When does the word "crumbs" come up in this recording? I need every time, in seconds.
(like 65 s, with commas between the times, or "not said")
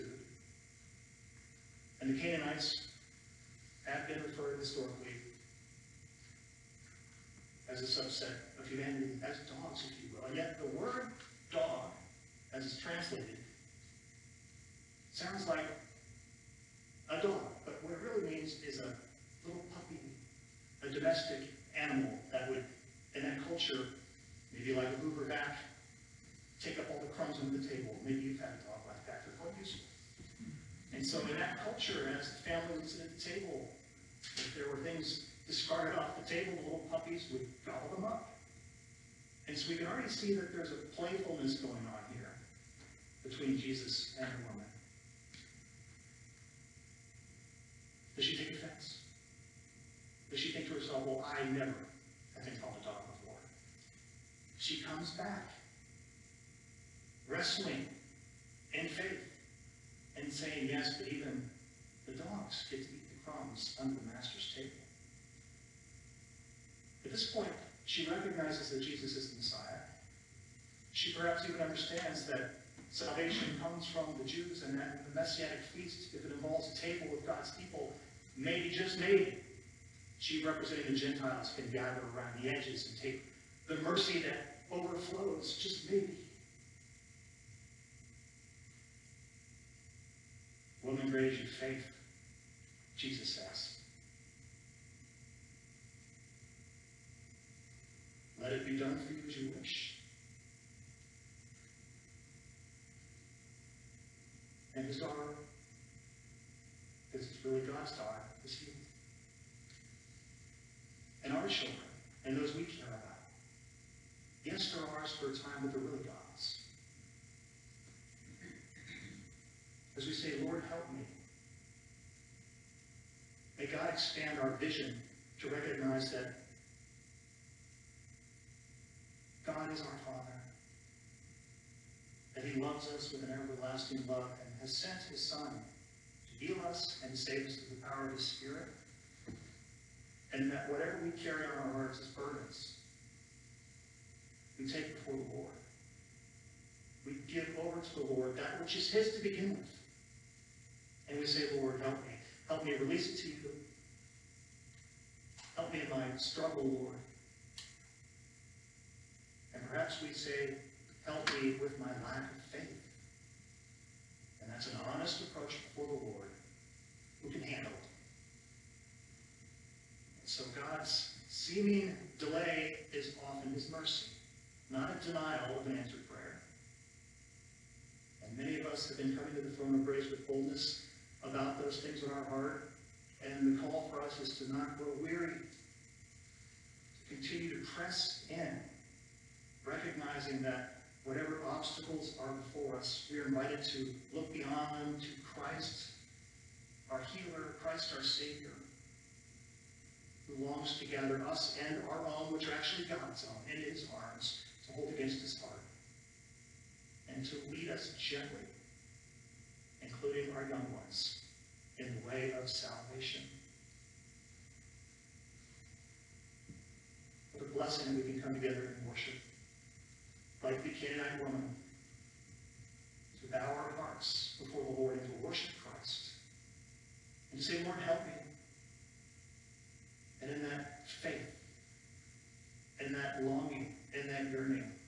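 27 s, 63 s.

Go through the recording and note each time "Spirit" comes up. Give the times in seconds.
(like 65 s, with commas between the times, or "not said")
138 s.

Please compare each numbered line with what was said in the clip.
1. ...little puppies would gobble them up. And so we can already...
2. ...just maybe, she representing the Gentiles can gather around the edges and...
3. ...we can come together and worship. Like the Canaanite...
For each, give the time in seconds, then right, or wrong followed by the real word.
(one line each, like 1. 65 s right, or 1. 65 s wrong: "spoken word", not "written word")
1. 36 s right
2. 78 s right
3. 217 s right.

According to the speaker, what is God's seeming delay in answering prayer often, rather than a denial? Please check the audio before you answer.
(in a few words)
his mercy.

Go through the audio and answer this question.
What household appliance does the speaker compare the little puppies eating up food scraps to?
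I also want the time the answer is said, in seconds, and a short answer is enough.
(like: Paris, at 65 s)
hoover, at 25 s.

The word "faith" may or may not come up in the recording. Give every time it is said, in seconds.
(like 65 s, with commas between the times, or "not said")
58 s, 91 s, 162 s, 230 s.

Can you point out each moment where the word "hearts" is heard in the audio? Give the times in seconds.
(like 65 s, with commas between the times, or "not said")
141 s, 182 s, 205 s, 223 s.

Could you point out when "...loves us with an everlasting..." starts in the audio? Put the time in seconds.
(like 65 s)
132 s.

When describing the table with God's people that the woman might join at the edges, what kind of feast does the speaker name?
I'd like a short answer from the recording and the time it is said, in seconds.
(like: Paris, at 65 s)
Messianic feast, at 75 s.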